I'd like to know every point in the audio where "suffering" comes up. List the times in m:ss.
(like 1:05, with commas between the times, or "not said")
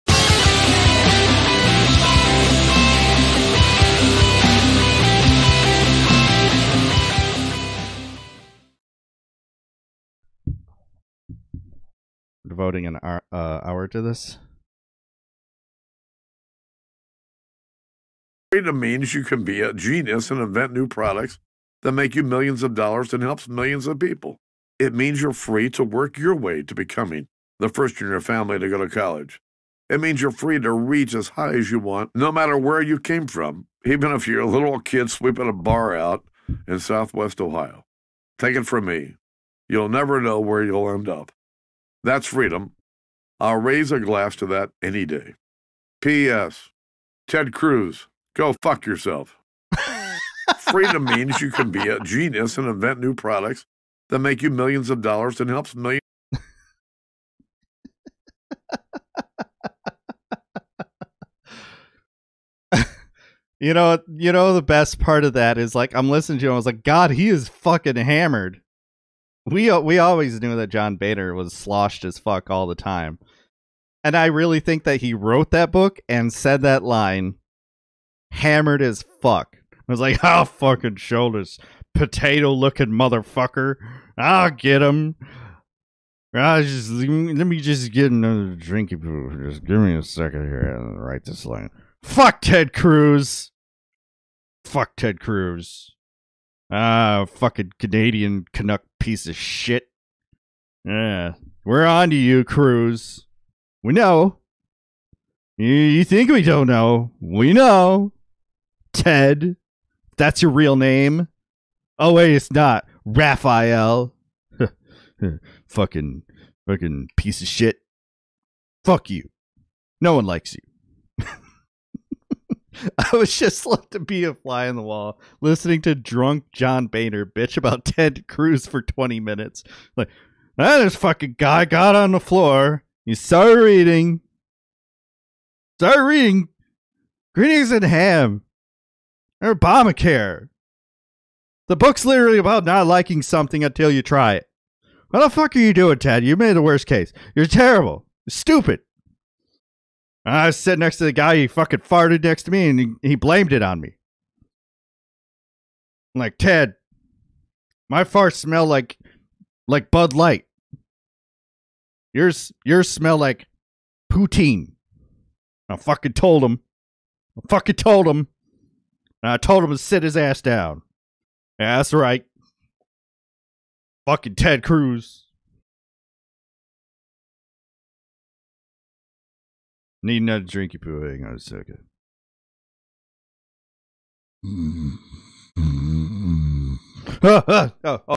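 not said.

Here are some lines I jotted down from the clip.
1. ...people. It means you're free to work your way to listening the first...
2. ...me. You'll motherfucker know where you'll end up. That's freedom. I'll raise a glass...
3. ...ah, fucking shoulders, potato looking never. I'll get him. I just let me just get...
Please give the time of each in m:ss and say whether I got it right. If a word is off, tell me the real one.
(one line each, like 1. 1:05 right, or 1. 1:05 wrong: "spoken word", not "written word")
1. 0:23 wrong: "becoming", not "listening"
2. 0:38 wrong: "never", not "motherfucker"
3. 1:20 wrong: "motherfucker", not "never".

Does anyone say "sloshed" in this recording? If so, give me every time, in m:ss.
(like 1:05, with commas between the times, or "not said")
1:11.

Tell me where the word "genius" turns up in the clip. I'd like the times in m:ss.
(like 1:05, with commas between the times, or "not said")
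0:19, 0:51.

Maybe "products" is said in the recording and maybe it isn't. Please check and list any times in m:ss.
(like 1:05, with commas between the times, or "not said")
0:20, 0:53.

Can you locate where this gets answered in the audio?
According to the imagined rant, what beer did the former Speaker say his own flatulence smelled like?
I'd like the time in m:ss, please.
2:39.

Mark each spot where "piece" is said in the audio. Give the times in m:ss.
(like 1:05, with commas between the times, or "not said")
1:38, 1:57.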